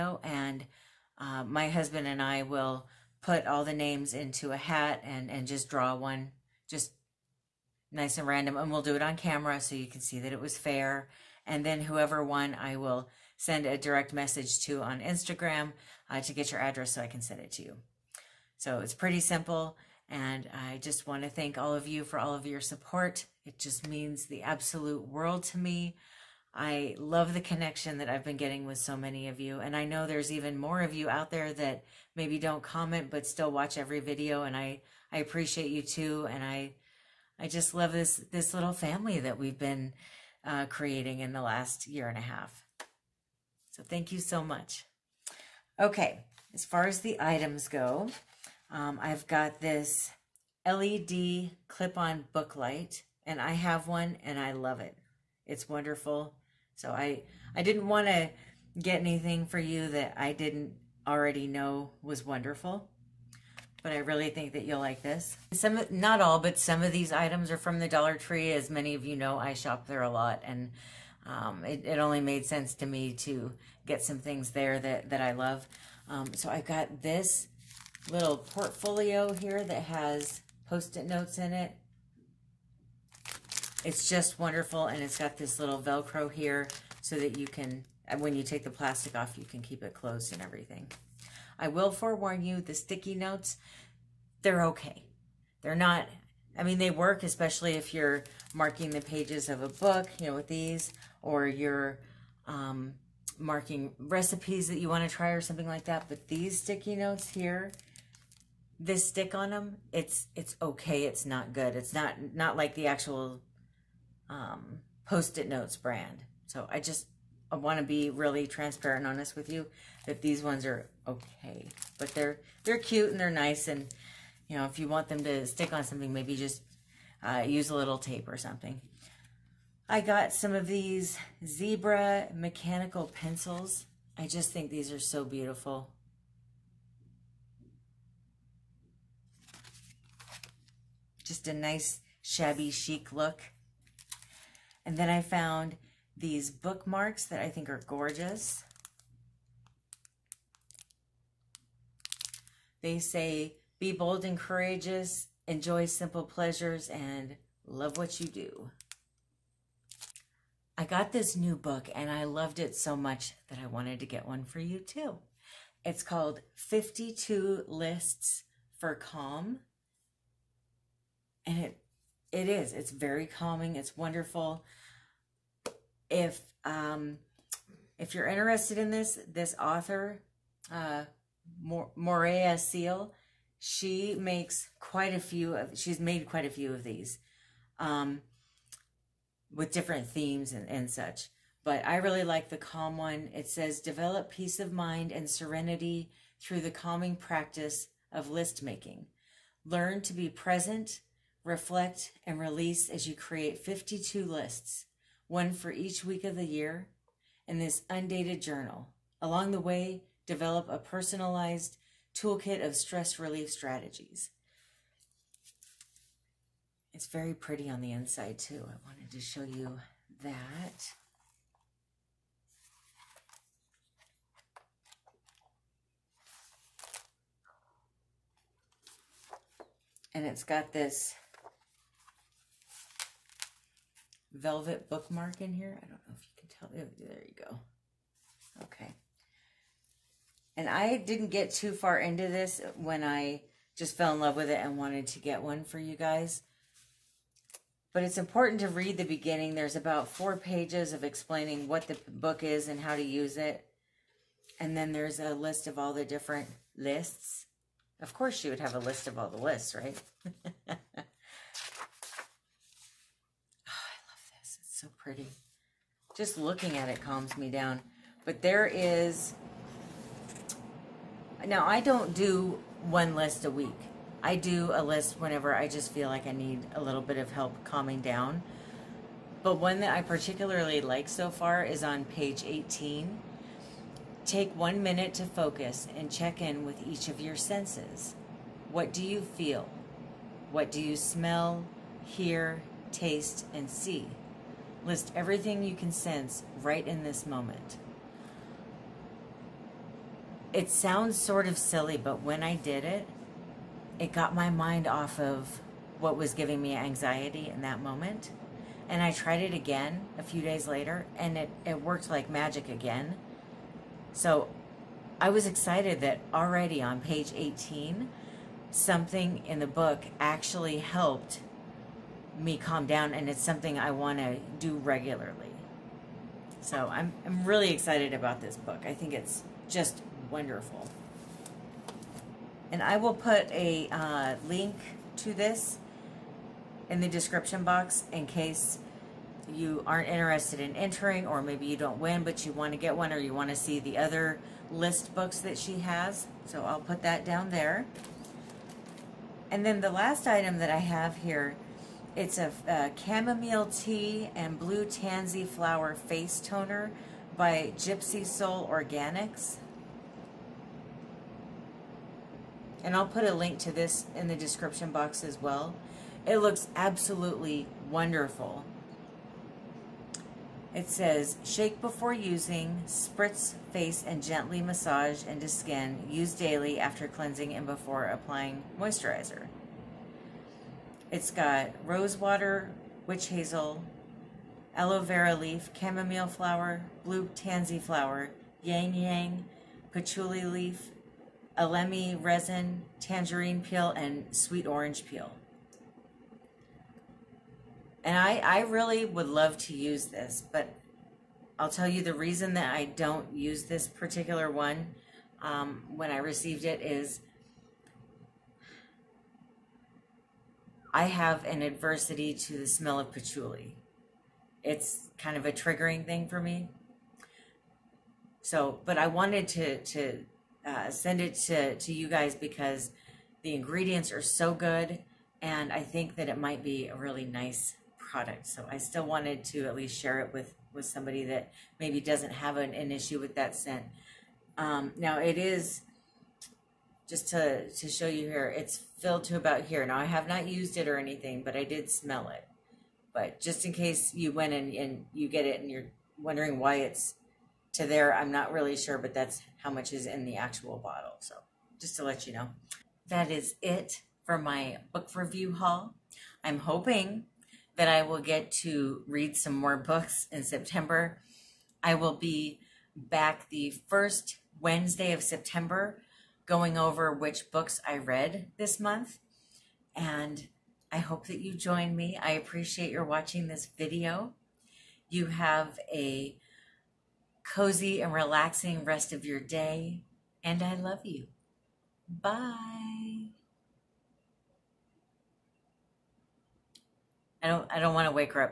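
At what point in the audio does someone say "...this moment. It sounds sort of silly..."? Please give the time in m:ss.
4:57.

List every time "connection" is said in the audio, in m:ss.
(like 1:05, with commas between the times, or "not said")
0:27.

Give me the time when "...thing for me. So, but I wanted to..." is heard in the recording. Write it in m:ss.
6:56.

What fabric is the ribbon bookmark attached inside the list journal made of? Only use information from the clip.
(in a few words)
Velvet.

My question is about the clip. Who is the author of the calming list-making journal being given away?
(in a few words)
Moorea Seal.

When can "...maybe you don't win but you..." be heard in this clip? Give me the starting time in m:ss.
5:41.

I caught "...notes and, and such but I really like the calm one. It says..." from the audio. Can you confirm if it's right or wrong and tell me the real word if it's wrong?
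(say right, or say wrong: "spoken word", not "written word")
wrong: "themes", not "notes".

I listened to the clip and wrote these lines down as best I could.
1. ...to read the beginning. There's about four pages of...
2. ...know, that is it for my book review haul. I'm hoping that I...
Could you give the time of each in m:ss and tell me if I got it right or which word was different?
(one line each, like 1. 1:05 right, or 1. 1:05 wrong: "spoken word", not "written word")
1. 4:08 right
2. 7:32 right.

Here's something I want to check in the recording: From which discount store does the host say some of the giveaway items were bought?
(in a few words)
Dollar Tree.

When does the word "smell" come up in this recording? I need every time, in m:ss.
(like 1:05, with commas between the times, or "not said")
4:50, 6:52, 7:21.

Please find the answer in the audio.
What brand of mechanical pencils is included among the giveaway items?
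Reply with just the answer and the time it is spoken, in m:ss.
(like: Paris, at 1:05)
Zebra, at 2:11.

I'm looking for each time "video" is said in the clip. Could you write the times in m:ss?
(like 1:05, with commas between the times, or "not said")
0:34, 7:53.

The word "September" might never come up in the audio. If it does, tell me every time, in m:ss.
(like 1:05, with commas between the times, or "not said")
7:40, 7:45.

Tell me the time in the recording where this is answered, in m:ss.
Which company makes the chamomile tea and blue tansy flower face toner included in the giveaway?
5:57.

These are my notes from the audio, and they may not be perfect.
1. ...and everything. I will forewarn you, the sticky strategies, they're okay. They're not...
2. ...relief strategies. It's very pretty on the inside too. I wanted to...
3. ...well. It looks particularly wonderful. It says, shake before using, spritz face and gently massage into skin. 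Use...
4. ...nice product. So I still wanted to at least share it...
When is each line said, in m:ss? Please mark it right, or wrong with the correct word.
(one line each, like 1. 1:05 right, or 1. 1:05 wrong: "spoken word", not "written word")
1. 1:30 wrong: "notes", not "strategies"
2. 3:33 right
3. 6:05 wrong: "absolutely", not "particularly"
4. 7:07 right.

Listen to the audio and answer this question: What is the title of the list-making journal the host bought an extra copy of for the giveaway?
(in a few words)
52 Lists for Calm.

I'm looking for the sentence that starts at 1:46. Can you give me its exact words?
But these sticky notes here, this stick on them, it's it's okay.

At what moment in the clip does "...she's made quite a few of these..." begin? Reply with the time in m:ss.
3:05.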